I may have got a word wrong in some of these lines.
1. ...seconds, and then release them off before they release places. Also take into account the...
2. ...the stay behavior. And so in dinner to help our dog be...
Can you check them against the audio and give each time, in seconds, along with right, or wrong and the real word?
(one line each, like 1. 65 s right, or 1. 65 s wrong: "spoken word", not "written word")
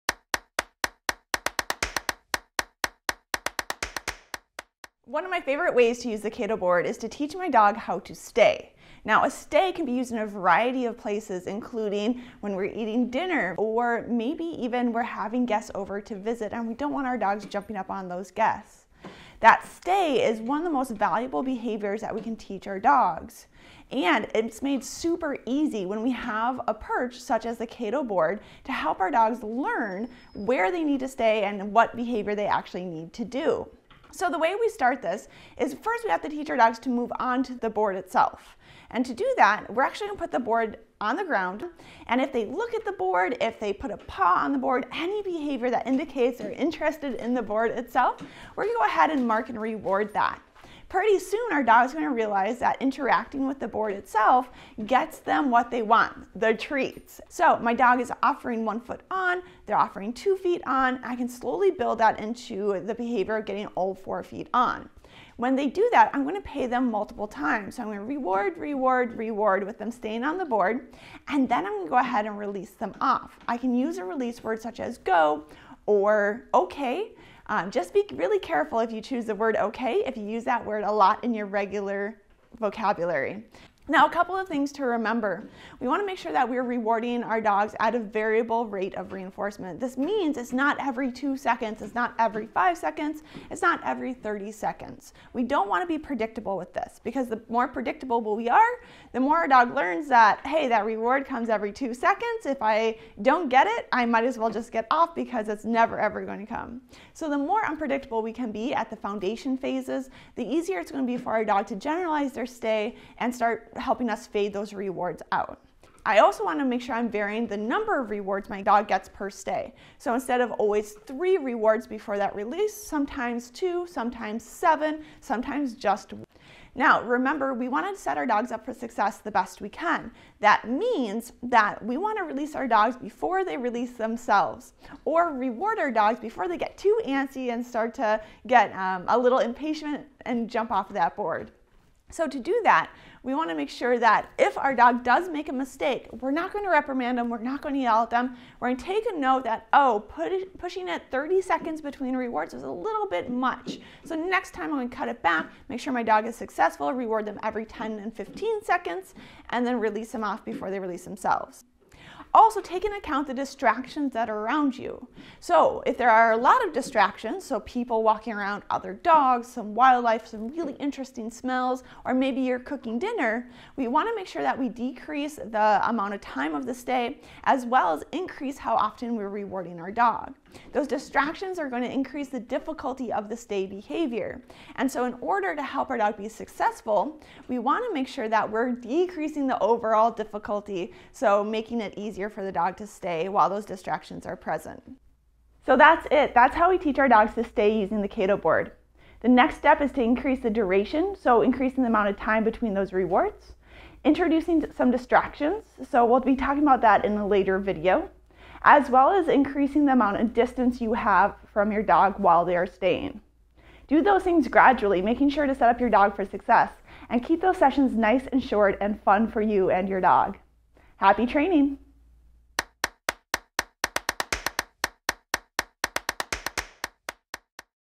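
1. 158 s wrong: "themselves", not "places"
2. 183 s wrong: "order", not "dinner".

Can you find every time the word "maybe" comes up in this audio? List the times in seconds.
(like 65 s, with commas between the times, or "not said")
14 s, 172 s.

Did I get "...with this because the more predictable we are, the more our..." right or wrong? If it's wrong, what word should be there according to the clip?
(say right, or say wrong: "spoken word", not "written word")
right.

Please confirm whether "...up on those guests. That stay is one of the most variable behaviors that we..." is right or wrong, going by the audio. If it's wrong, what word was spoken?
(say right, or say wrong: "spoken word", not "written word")
wrong: "valuable", not "variable".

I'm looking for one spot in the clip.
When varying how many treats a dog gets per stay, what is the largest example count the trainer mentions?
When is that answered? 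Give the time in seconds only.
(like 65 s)
124 s.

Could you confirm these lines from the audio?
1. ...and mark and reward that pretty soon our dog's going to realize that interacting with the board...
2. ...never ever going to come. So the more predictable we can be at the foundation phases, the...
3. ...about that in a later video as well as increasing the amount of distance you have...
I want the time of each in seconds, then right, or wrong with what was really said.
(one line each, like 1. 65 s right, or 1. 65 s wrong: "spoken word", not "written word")
1. 49 s right
2. 105 s wrong: "unpredictable", not "predictable"
3. 206 s right.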